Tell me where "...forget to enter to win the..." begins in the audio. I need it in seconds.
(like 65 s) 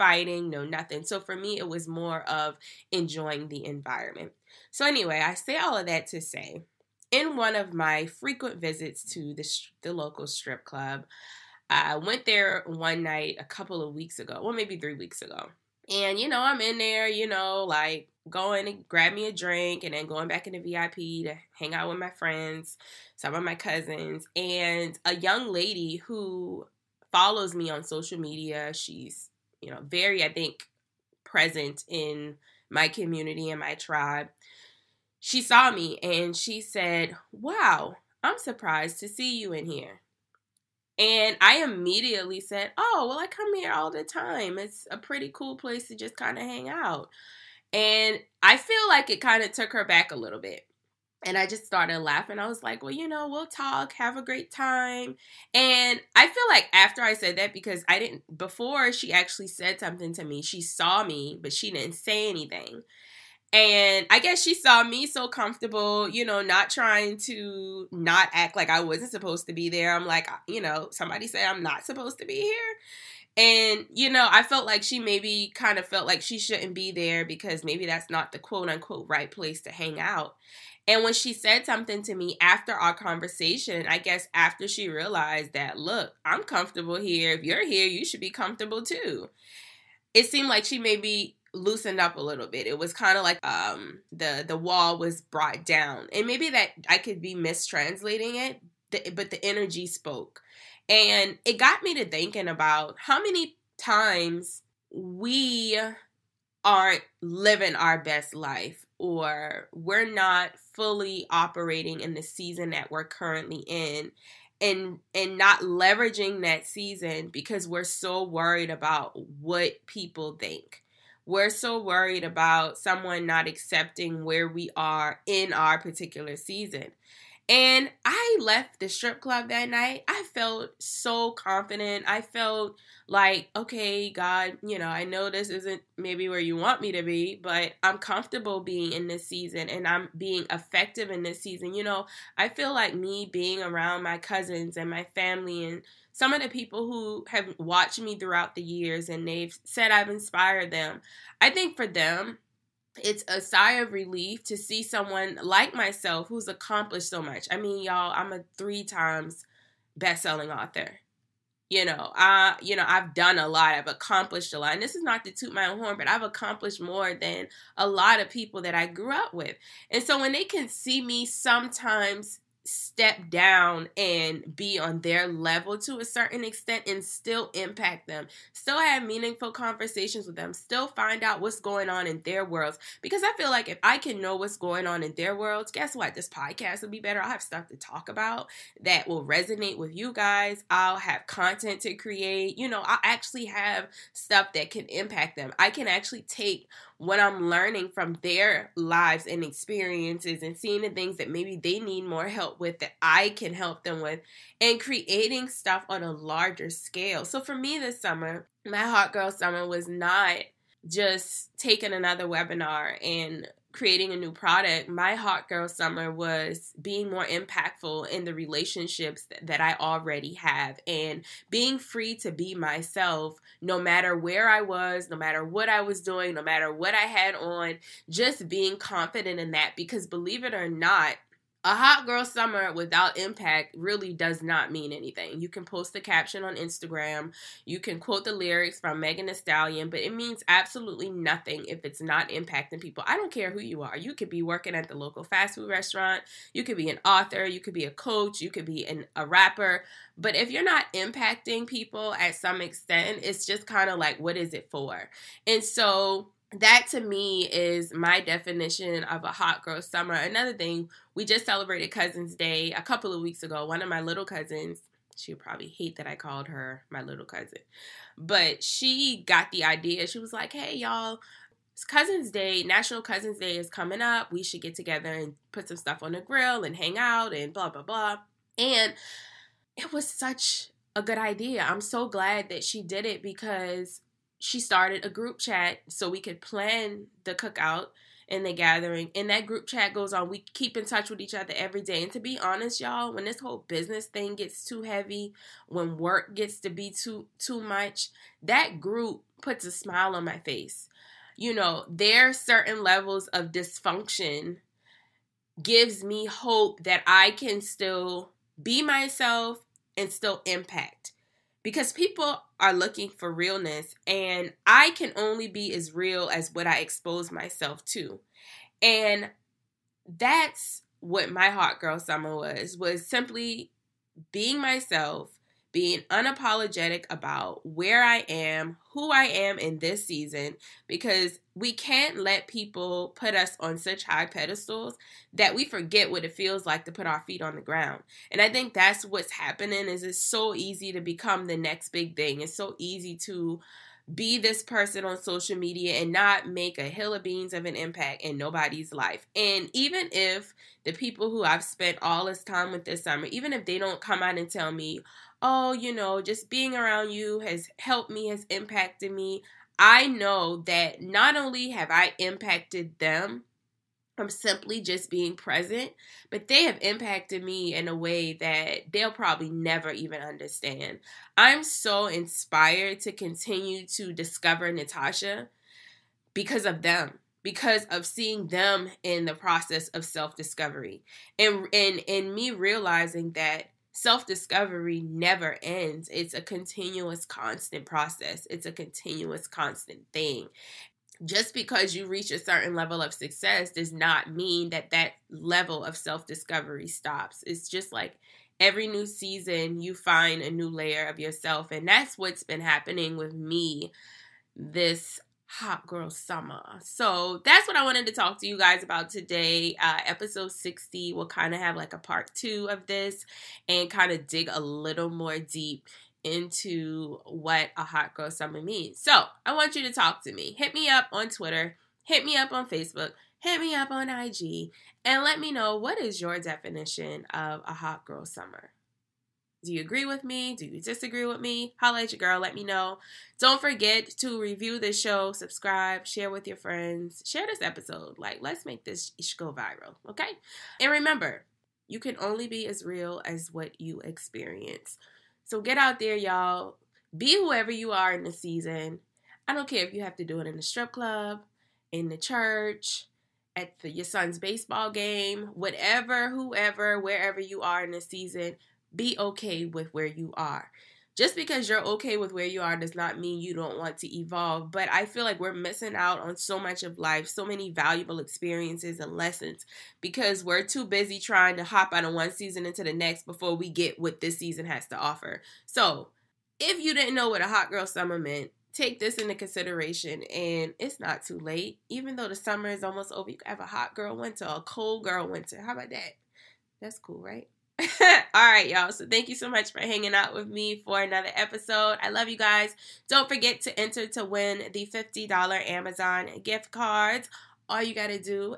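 493 s.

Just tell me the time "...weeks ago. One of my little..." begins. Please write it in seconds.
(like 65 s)
263 s.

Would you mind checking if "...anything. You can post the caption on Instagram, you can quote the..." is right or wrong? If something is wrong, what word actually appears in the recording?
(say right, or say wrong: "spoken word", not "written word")
right.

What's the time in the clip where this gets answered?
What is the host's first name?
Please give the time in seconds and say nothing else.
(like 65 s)
374 s.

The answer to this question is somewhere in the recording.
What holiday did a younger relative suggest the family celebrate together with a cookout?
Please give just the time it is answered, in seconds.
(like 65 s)
272 s.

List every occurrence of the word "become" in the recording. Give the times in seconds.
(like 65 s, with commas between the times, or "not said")
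341 s.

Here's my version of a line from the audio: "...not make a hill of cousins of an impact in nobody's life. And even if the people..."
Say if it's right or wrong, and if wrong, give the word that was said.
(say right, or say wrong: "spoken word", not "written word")
wrong: "beans", not "cousins".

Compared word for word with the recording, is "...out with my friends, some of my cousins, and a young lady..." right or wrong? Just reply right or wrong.
right.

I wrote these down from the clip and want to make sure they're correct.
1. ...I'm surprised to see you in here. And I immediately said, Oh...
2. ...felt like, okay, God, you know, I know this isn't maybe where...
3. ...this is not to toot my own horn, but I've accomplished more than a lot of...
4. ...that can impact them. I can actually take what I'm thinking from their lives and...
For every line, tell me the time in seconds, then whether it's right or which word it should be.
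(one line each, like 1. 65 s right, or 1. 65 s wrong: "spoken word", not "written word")
1. 38 s right
2. 132 s right
3. 164 s right
4. 194 s wrong: "learning", not "thinking".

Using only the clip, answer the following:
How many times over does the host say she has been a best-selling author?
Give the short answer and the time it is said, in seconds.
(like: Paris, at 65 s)
3, at 158 s.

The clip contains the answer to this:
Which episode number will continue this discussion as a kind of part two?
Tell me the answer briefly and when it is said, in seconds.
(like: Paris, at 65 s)
60, at 410 s.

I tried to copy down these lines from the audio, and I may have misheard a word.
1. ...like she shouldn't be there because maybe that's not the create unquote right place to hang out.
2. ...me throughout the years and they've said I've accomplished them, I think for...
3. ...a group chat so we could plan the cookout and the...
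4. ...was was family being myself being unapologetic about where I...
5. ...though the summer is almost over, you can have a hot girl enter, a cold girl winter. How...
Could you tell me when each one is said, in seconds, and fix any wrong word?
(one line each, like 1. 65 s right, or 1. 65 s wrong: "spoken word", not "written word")
1. 76 s wrong: "quote", not "create"
2. 147 s wrong: "inspired", not "accomplished"
3. 285 s right
4. 322 s wrong: "simply", not "family"
5. 482 s wrong: "winter", not "enter".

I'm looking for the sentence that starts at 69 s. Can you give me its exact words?
I'm like, you know, somebody say I'm not supposed to be here.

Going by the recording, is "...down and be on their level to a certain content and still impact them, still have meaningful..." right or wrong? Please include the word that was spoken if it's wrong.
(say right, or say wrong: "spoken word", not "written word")
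wrong: "extent", not "content".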